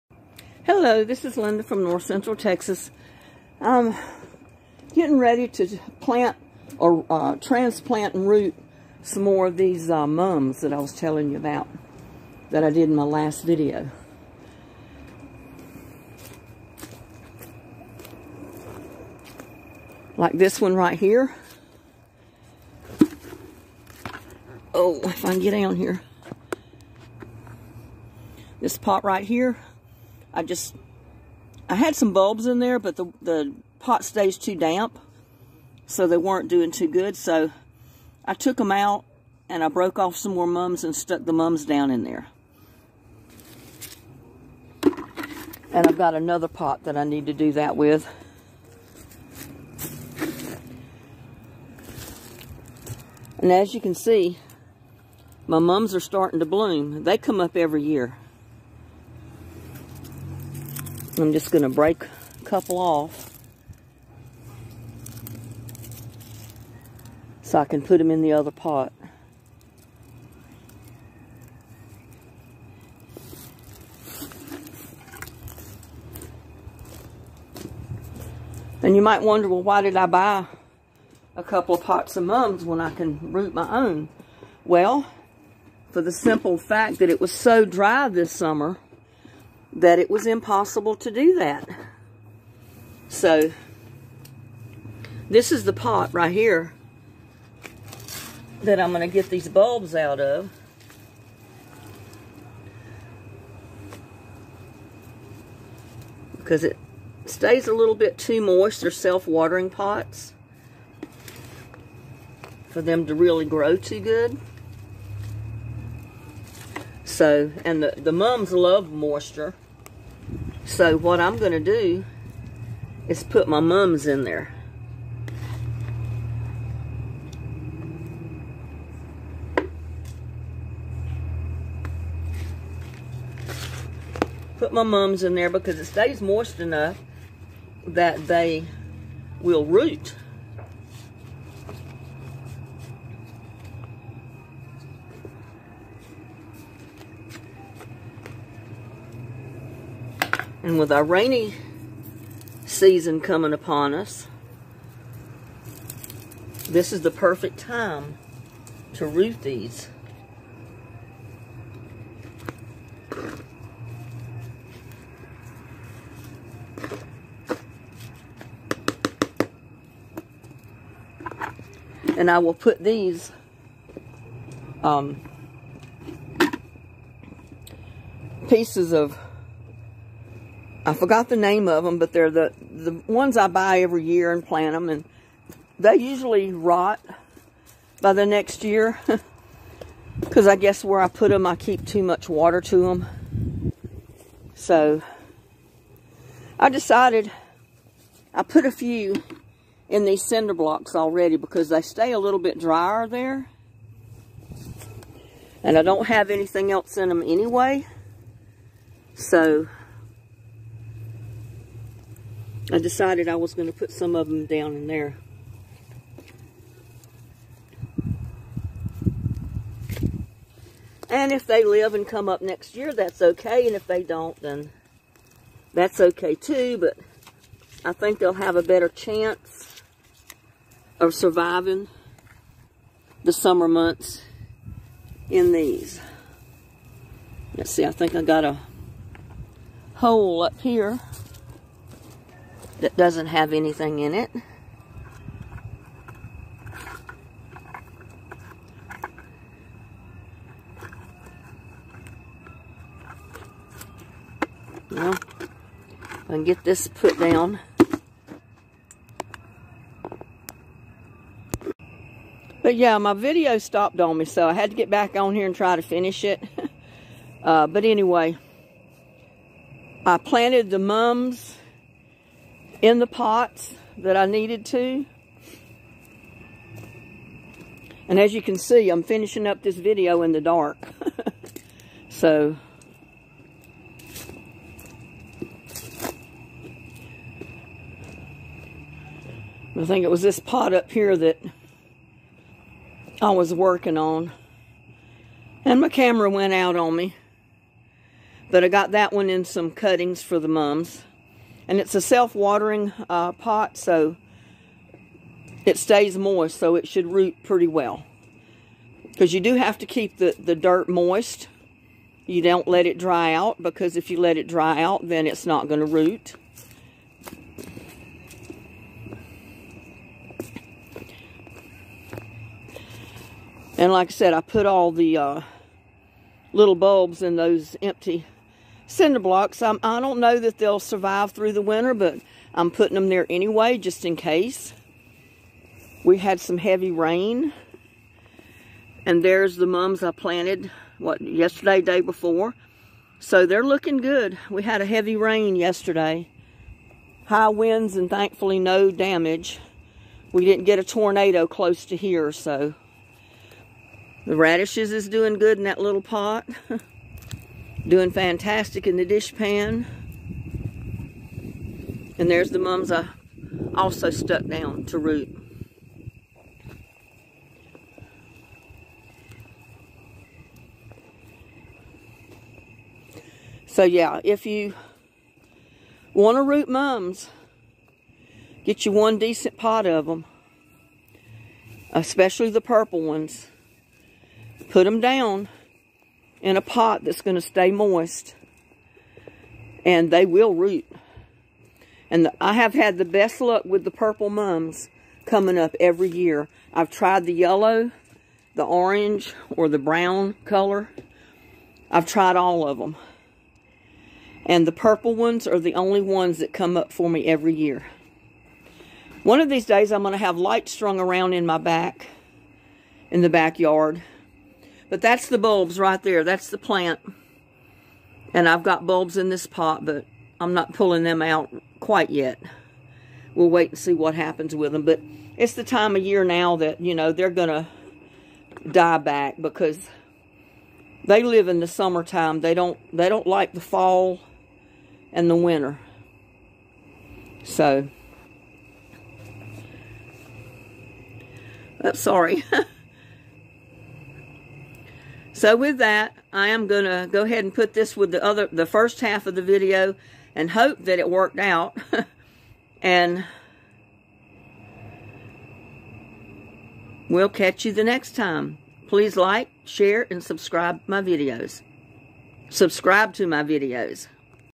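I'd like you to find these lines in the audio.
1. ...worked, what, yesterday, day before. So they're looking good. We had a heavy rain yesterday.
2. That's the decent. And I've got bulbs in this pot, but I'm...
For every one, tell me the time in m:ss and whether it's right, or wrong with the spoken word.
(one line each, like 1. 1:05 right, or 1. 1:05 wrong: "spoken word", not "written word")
1. 5:40 wrong: "planted", not "worked"
2. 6:56 wrong: "plant", not "decent".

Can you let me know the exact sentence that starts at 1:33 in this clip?
So, this is the pot right here that I'm going to get these bulbs out of.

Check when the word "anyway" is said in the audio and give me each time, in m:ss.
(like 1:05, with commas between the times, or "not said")
3:27, 4:27, 5:33.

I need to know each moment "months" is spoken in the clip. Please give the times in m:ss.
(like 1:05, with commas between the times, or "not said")
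3:53.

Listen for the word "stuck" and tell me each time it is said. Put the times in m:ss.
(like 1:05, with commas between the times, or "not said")
0:40, 6:04.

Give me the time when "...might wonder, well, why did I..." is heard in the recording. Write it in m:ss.
1:19.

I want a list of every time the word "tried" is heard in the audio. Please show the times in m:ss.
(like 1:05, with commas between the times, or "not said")
6:36, 6:42.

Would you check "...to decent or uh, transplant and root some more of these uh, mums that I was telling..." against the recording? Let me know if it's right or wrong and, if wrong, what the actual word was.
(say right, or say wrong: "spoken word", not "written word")
wrong: "plant", not "decent".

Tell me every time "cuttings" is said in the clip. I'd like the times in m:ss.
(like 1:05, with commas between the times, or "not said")
4:59.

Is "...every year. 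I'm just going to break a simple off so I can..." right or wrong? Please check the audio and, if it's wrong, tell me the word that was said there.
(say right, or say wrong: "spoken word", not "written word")
wrong: "couple", not "simple".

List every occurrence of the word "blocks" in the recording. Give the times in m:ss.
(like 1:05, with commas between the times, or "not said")
3:20, 5:29.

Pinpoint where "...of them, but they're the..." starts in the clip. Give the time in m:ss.
3:01.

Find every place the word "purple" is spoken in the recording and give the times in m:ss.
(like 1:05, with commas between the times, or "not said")
6:22, 6:33, 6:44.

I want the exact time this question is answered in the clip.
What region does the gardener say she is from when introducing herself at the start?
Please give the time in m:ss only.
0:01.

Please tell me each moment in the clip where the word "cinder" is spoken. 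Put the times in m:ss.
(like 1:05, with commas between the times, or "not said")
3:20, 5:28.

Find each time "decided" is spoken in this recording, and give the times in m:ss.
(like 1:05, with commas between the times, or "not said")
3:16, 3:32.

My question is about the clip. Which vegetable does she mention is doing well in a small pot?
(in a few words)
Radishes.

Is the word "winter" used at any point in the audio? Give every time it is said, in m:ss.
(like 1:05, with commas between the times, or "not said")
5:31, 7:15.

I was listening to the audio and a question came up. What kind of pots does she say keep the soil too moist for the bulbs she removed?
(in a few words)
Self-watering pots.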